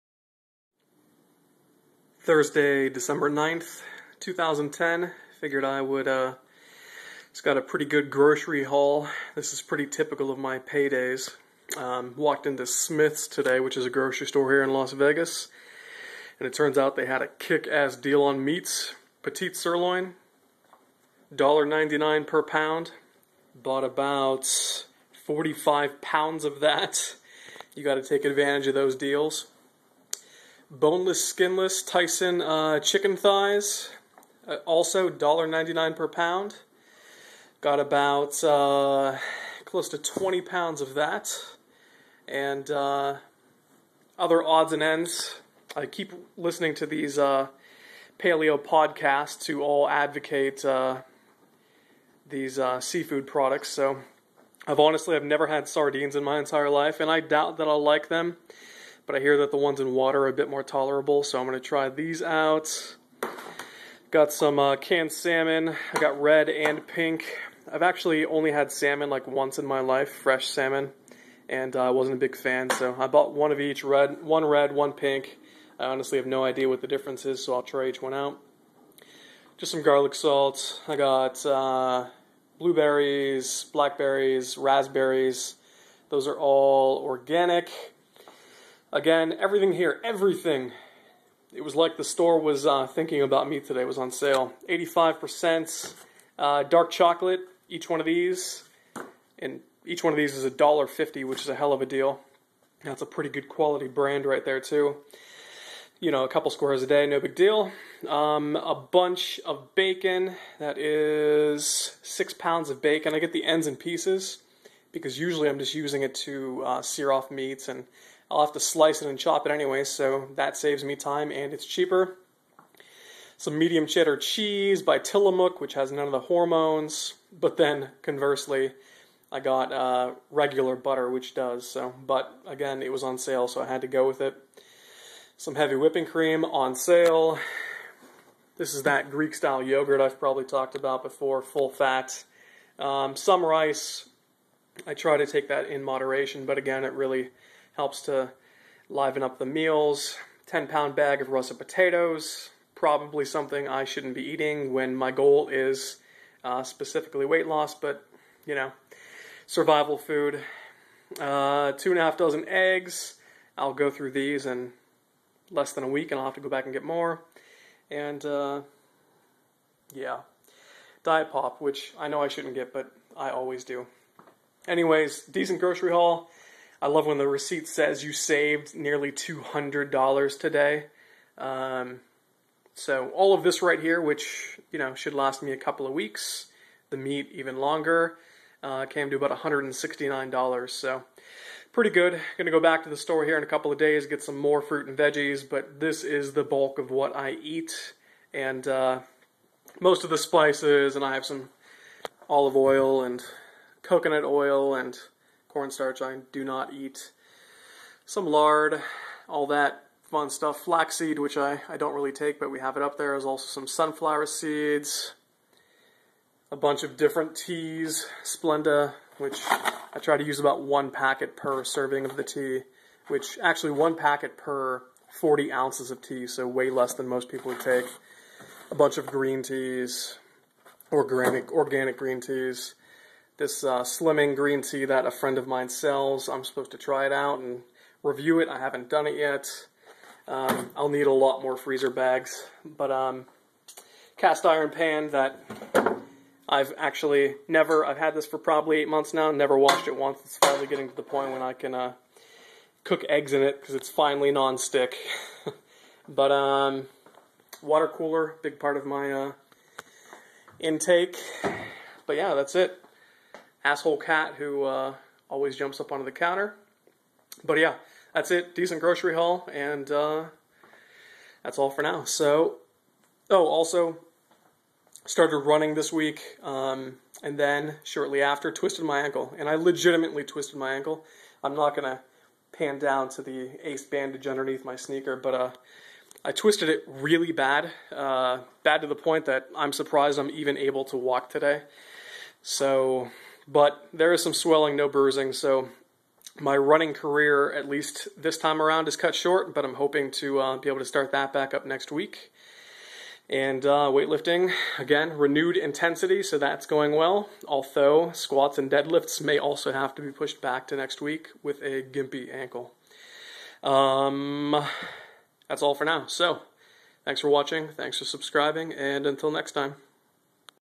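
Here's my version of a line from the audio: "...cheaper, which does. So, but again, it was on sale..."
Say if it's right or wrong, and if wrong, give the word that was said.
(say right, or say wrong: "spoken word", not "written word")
wrong: "butter", not "cheaper".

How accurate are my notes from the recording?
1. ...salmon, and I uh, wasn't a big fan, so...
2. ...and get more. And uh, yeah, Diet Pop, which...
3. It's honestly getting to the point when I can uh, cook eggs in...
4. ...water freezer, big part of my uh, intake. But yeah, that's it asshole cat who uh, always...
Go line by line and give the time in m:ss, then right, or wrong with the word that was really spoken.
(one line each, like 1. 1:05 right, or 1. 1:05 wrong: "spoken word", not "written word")
1. 1:10 right
2. 2:46 right
3. 4:10 wrong: "finally", not "honestly"
4. 4:17 wrong: "cooler", not "freezer".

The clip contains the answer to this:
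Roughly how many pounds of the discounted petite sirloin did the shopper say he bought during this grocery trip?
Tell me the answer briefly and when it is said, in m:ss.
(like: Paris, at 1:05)
45 pounds, at 0:25.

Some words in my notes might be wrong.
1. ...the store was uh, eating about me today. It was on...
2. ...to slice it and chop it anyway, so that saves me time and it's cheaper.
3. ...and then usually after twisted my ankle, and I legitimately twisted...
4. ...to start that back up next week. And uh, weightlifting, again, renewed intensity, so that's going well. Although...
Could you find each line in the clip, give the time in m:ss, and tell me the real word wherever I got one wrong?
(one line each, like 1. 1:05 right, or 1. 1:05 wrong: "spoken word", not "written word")
1. 1:31 wrong: "thinking", not "eating"
2. 1:58 right
3. 4:37 wrong: "shortly", not "usually"
4. 5:00 right.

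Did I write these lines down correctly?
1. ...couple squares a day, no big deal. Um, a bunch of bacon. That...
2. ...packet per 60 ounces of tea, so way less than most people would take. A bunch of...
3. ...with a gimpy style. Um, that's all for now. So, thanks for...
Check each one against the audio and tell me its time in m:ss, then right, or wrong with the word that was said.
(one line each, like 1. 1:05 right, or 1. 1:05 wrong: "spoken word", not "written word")
1. 1:46 right
2. 3:43 wrong: "40", not "60"
3. 5:11 wrong: "ankle", not "style".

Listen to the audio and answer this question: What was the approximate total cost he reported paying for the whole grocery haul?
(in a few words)
$169.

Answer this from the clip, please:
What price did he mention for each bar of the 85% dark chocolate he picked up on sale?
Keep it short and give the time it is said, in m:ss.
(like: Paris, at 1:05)
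$1.50, at 1:40.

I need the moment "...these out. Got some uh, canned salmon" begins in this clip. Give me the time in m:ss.
1:01.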